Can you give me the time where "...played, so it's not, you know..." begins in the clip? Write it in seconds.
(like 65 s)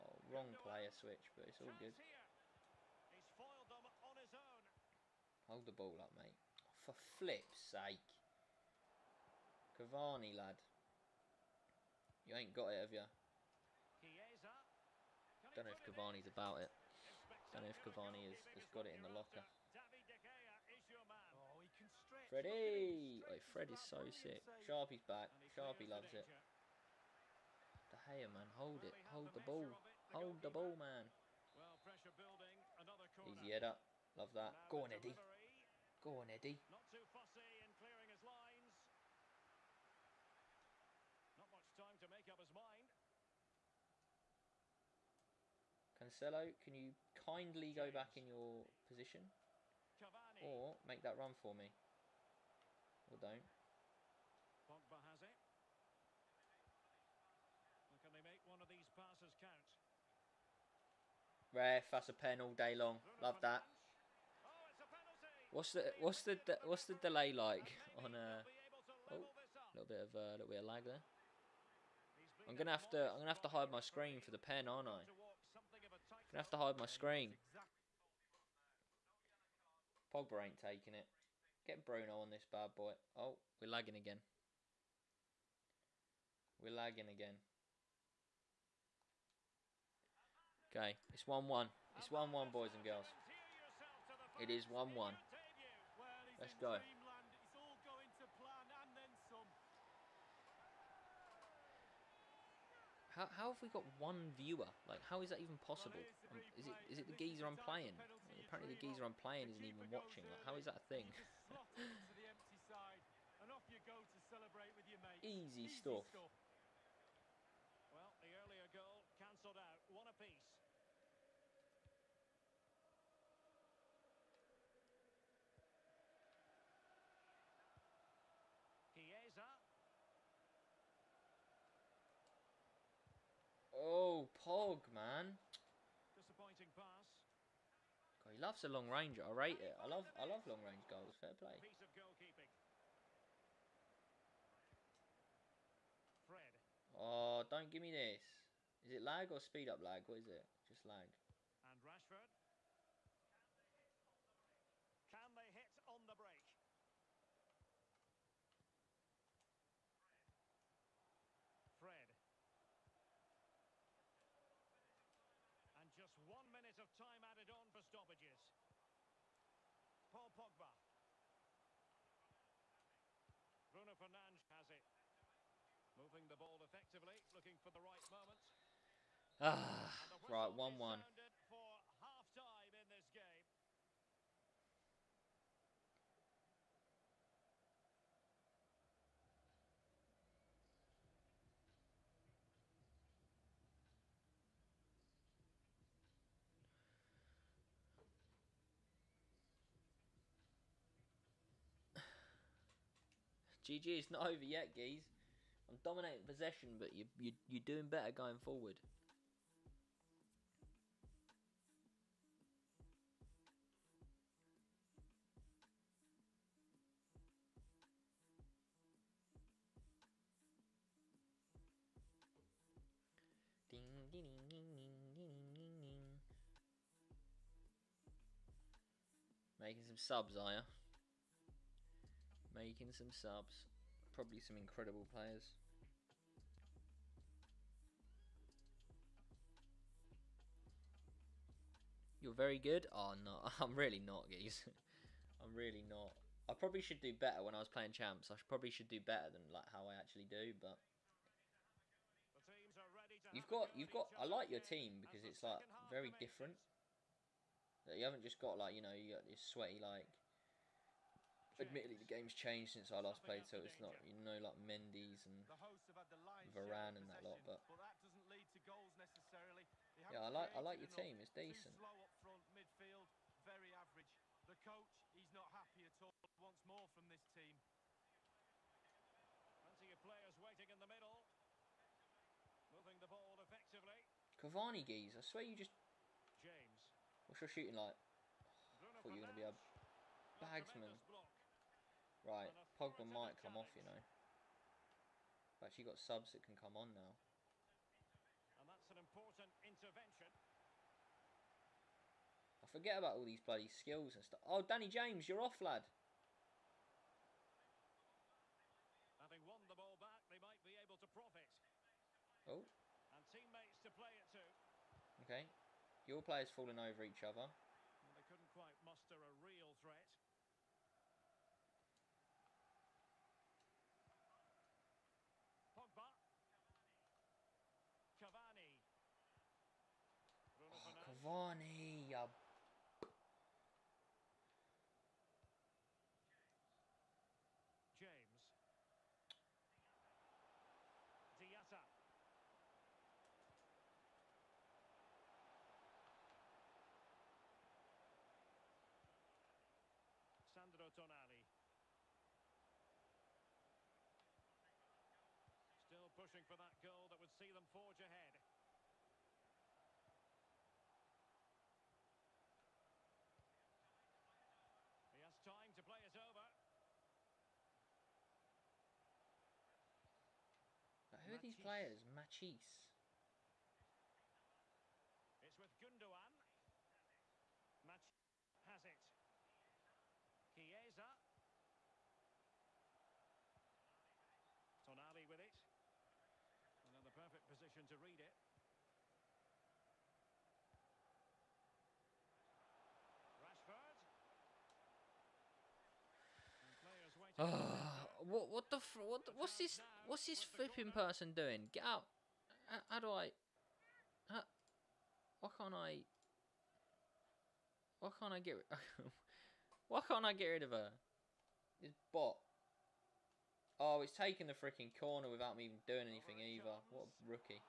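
263 s.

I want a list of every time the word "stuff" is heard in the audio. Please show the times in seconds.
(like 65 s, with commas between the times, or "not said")
115 s, 304 s.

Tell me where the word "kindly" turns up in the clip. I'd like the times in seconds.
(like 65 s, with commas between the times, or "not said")
47 s.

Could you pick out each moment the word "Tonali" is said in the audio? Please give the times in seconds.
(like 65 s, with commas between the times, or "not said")
350 s, 384 s.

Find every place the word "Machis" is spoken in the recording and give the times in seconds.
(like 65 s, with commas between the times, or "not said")
372 s.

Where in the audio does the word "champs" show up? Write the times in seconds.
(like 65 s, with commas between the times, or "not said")
247 s.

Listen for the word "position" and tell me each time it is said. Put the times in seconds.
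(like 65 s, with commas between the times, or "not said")
48 s, 387 s.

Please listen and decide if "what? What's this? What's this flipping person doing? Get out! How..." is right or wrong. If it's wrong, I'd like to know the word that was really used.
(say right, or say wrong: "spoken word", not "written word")
right.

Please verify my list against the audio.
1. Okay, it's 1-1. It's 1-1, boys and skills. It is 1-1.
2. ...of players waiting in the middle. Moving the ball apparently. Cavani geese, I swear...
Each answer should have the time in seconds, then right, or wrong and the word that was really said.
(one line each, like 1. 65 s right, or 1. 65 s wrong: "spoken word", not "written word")
1. 90 s wrong: "girls", not "skills"
2. 279 s wrong: "effectively", not "apparently".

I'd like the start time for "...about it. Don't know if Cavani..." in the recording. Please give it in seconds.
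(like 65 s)
16 s.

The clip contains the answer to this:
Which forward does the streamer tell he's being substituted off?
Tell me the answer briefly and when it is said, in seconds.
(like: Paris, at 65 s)
Danny James, at 304 s.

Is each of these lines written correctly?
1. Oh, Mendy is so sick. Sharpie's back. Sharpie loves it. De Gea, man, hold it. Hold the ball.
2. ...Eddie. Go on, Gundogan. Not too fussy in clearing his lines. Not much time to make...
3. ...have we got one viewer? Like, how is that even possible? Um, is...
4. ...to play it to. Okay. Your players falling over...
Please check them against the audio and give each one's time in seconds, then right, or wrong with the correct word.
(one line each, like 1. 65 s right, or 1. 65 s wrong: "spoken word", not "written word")
1. 23 s wrong: "Fred", not "Mendy"
2. 34 s wrong: "Eddie", not "Gundogan"
3. 103 s right
4. 313 s right.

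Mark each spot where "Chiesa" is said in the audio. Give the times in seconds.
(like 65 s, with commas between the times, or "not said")
120 s, 380 s.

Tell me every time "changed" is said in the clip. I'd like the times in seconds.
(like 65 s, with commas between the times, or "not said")
262 s.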